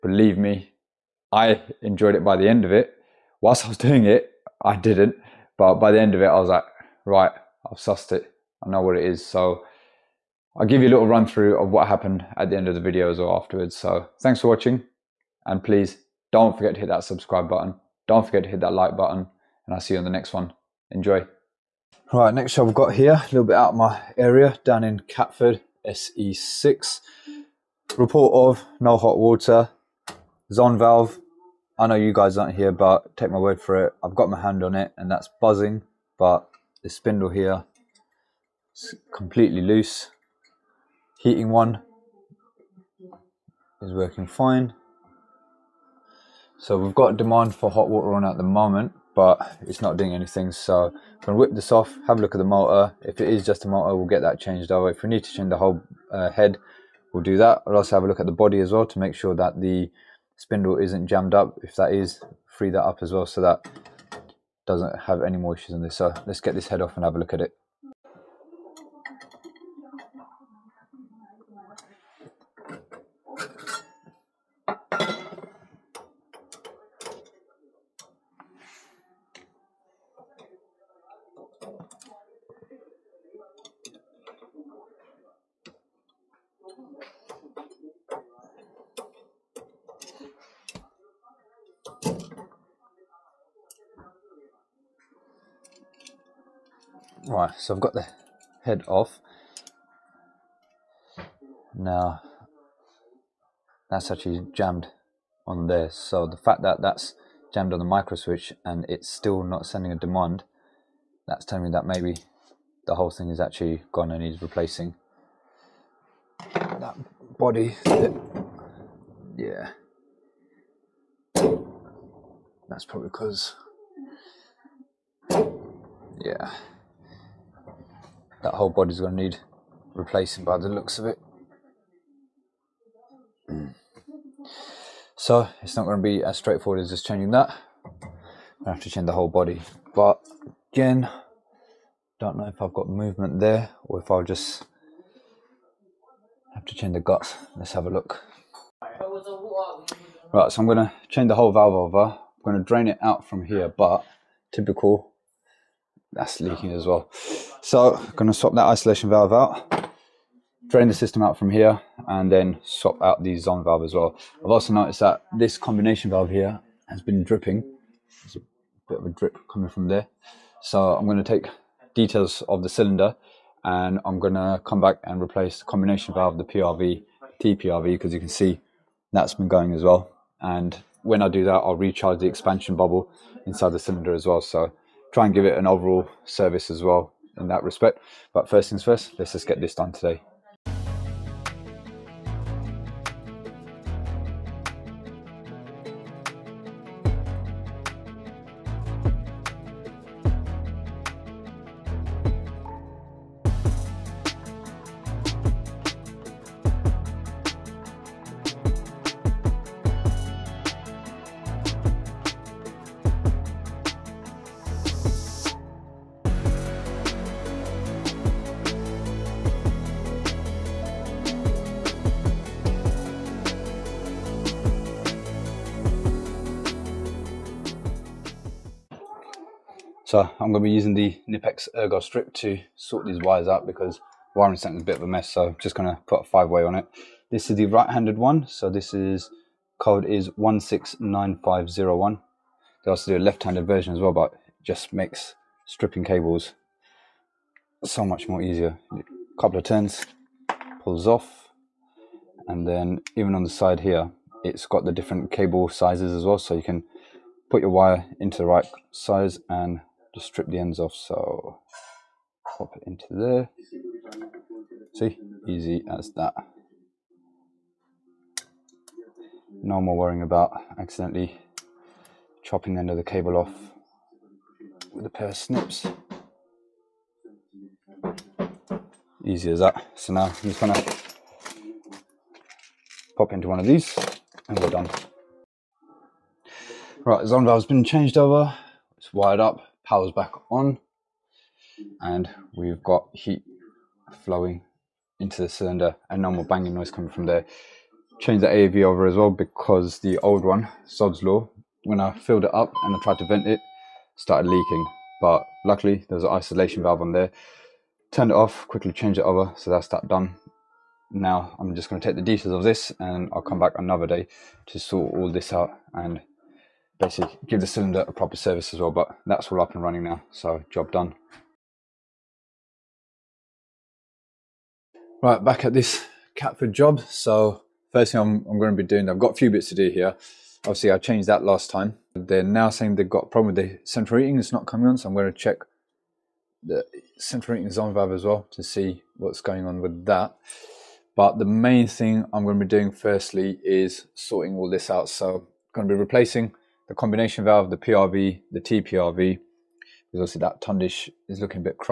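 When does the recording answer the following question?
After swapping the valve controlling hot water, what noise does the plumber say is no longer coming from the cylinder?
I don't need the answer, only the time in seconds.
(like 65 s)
296 s.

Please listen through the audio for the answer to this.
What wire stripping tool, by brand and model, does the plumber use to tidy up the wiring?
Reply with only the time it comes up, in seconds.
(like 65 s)
231 s.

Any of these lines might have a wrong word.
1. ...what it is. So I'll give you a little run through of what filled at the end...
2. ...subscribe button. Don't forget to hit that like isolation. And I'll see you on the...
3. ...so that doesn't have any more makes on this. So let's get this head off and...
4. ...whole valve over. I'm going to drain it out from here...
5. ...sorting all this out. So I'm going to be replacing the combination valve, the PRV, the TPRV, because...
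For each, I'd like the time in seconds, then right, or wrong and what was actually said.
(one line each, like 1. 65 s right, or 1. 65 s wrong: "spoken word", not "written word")
1. 8 s wrong: "happened", not "filled"
2. 17 s wrong: "button", not "isolation"
3. 63 s wrong: "issues", not "makes"
4. 151 s right
5. 344 s right.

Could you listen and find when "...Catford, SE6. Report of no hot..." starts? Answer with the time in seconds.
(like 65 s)
25 s.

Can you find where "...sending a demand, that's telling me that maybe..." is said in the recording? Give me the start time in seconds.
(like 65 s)
109 s.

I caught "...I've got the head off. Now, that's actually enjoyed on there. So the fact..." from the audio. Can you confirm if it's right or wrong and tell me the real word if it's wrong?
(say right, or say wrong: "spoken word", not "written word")
wrong: "jammed", not "enjoyed".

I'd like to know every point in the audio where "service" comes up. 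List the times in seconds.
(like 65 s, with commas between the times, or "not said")
186 s, 318 s.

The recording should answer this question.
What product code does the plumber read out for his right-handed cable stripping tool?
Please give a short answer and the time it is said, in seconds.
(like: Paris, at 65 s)
169501, at 240 s.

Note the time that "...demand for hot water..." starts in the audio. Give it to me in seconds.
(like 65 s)
47 s.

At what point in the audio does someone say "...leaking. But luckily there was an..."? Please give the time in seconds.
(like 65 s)
304 s.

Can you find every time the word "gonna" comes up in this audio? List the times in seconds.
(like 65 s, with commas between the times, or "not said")
51 s, 280 s.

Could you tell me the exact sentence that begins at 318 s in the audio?
But that's all up and running now, so job done.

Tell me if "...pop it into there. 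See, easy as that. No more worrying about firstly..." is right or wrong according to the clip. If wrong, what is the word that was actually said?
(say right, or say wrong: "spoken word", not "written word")
wrong: "accidentally", not "firstly".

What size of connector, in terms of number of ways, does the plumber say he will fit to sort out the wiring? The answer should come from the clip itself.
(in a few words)
five way.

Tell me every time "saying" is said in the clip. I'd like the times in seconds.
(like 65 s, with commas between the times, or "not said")
332 s.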